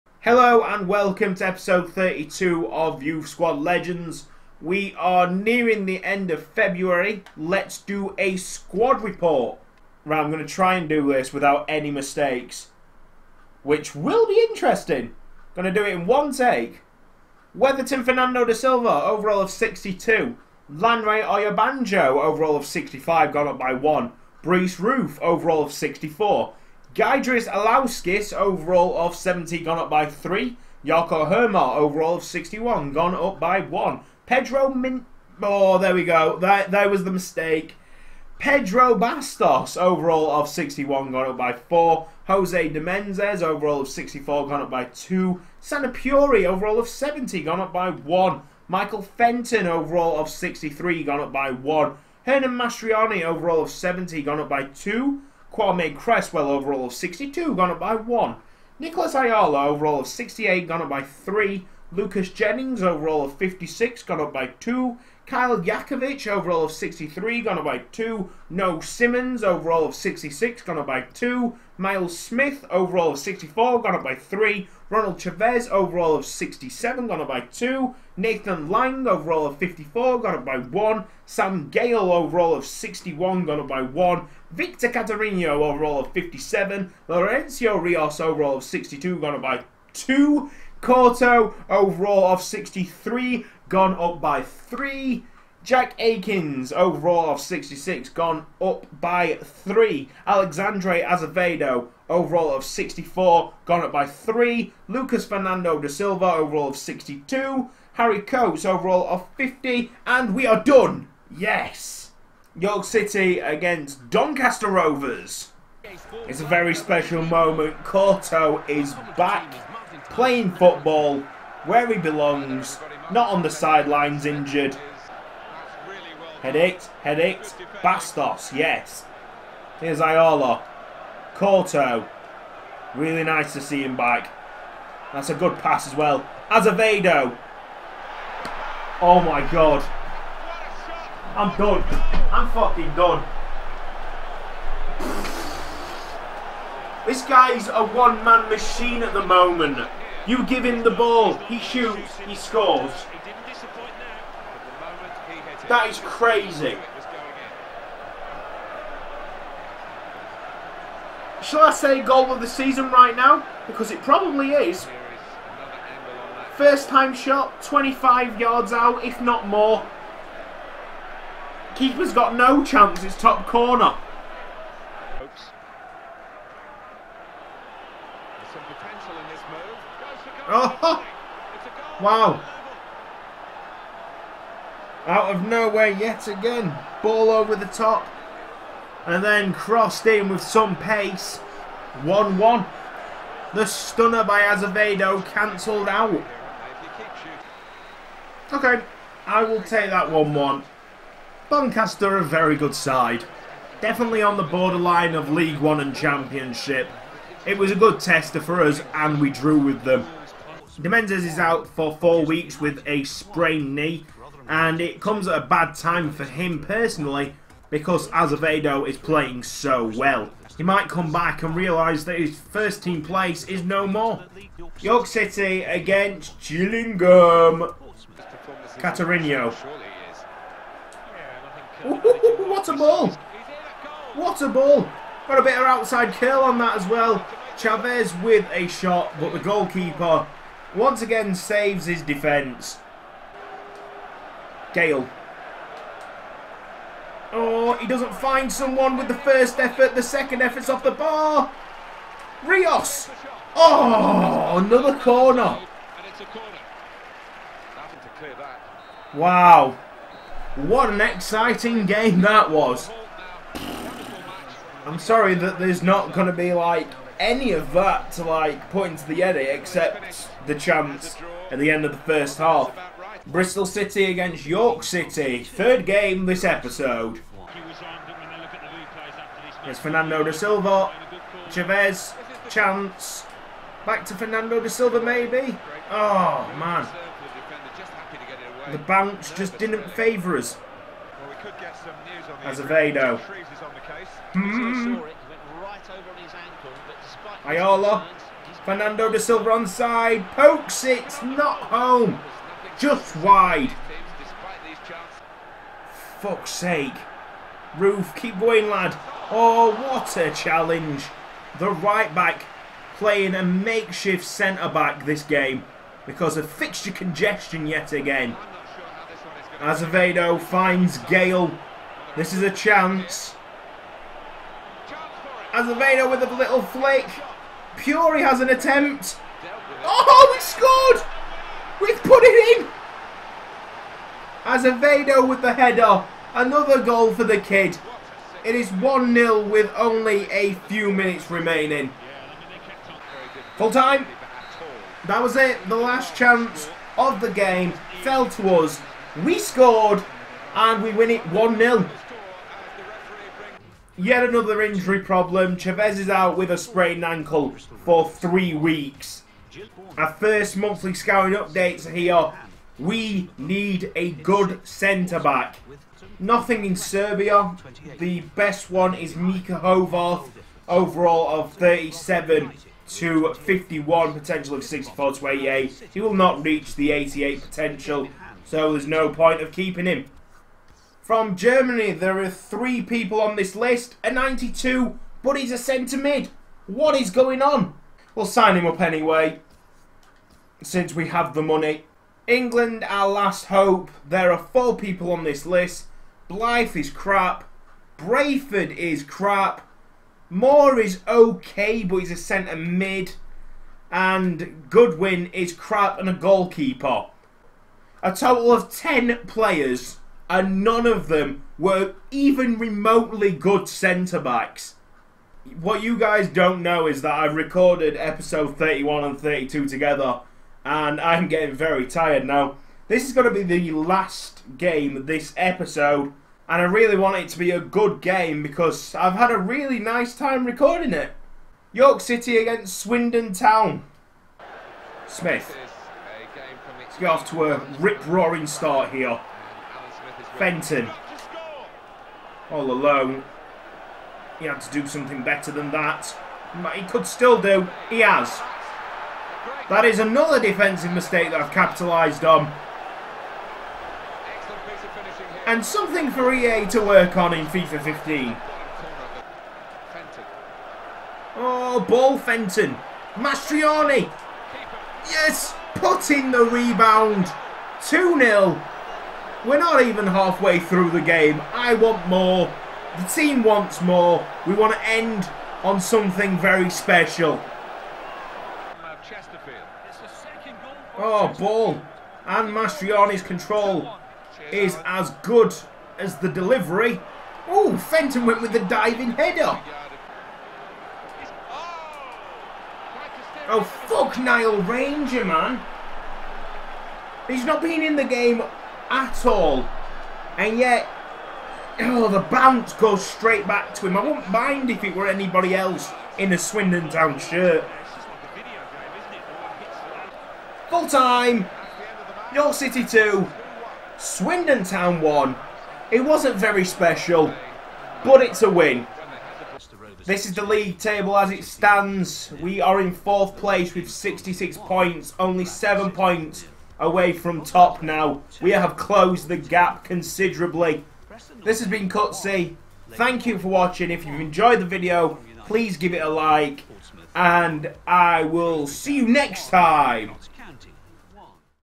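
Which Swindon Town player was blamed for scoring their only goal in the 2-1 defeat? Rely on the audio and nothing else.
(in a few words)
Nile Ranger.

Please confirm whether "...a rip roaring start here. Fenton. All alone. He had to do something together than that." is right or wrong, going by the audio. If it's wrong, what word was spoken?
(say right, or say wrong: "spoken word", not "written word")
wrong: "better", not "together".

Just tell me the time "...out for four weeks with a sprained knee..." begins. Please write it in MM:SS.
03:31.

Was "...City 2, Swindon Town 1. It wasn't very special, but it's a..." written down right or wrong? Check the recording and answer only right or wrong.
right.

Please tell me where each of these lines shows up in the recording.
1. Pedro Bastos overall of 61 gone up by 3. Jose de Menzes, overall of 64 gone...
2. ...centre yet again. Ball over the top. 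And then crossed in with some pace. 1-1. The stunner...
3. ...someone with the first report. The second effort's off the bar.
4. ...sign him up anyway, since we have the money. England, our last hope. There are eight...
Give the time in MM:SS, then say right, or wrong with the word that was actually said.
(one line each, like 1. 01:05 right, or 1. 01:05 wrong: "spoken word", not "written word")
1. 00:38 wrong: "4", not "3"
2. 03:05 wrong: "nowhere", not "centre"
3. 04:08 wrong: "effort", not "report"
4. 06:28 wrong: "four", not "eight".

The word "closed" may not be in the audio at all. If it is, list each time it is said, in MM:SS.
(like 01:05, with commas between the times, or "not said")
08:48.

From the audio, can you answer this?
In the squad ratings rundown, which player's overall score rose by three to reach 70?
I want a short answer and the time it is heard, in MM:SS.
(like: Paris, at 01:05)
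Gydris Alauskis, at 00:26.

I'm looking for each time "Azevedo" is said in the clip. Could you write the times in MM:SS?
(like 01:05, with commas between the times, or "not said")
01:41, 02:16, 03:14, 03:38, 04:52, 05:19, 05:25, 05:34.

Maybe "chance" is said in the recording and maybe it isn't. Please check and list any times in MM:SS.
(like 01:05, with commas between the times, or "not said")
02:52, 04:30, 04:42, 05:22, 05:46.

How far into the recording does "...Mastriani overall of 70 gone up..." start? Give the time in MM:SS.
00:52.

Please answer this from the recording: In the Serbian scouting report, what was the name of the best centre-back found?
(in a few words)
Mika Hovarth.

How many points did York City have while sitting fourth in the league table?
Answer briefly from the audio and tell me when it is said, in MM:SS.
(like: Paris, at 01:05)
66, at 08:43.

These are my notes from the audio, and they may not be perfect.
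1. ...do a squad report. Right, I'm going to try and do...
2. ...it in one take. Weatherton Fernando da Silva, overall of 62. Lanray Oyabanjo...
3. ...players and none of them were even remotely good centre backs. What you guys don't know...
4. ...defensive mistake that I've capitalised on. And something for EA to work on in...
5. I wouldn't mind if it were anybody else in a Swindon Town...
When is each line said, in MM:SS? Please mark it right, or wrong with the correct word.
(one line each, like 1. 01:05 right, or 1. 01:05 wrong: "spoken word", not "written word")
1. 00:07 right
2. 00:15 right
3. 06:49 right
4. 07:30 right
5. 08:23 right.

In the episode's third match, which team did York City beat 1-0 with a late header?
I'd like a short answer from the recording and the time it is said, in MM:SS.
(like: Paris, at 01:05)
Bristol City, at 04:33.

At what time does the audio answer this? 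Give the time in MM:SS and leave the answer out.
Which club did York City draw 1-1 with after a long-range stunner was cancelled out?
01:54.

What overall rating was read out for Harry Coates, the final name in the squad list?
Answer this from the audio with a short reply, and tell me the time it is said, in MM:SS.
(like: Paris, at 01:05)
50, at 01:48.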